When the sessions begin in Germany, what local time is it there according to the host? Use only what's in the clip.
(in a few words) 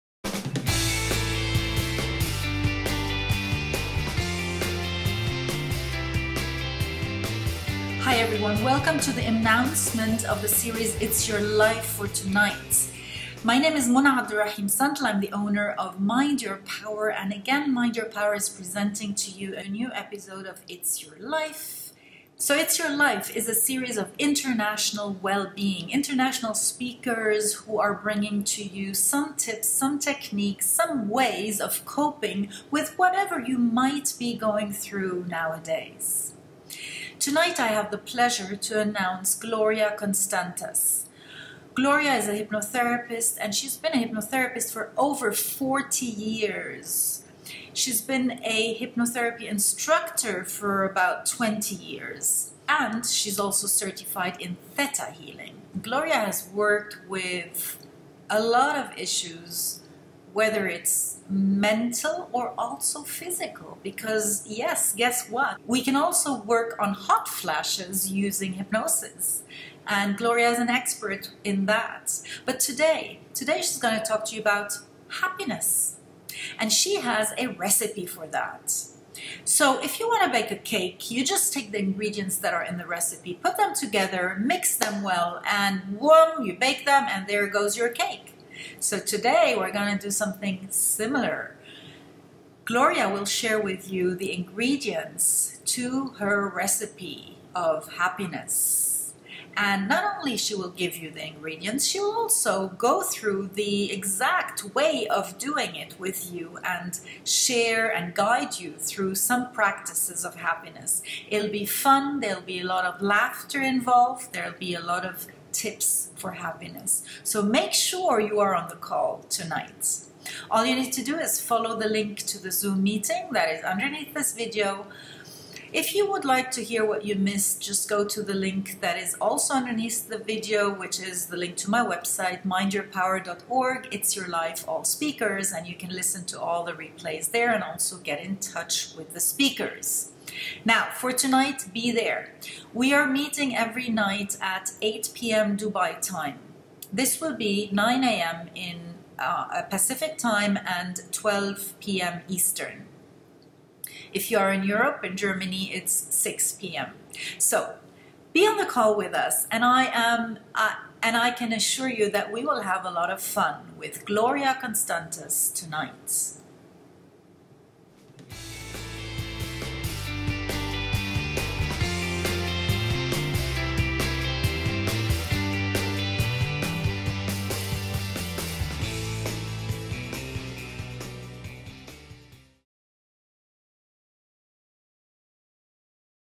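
6 p.m.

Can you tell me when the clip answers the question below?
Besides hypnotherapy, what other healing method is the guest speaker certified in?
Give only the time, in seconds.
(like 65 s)
54 s.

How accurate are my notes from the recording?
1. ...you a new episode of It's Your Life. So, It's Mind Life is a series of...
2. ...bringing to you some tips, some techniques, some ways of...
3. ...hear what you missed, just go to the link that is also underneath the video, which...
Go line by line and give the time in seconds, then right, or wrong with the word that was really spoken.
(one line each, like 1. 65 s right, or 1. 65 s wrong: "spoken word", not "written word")
1. 19 s wrong: "Your", not "Mind"
2. 27 s right
3. 126 s right.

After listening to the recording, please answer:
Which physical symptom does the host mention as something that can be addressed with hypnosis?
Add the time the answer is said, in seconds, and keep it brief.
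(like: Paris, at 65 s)
Hot flashes, at 66 s.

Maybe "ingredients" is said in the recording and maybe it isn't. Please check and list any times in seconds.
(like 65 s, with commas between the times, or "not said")
81 s, 94 s, 101 s.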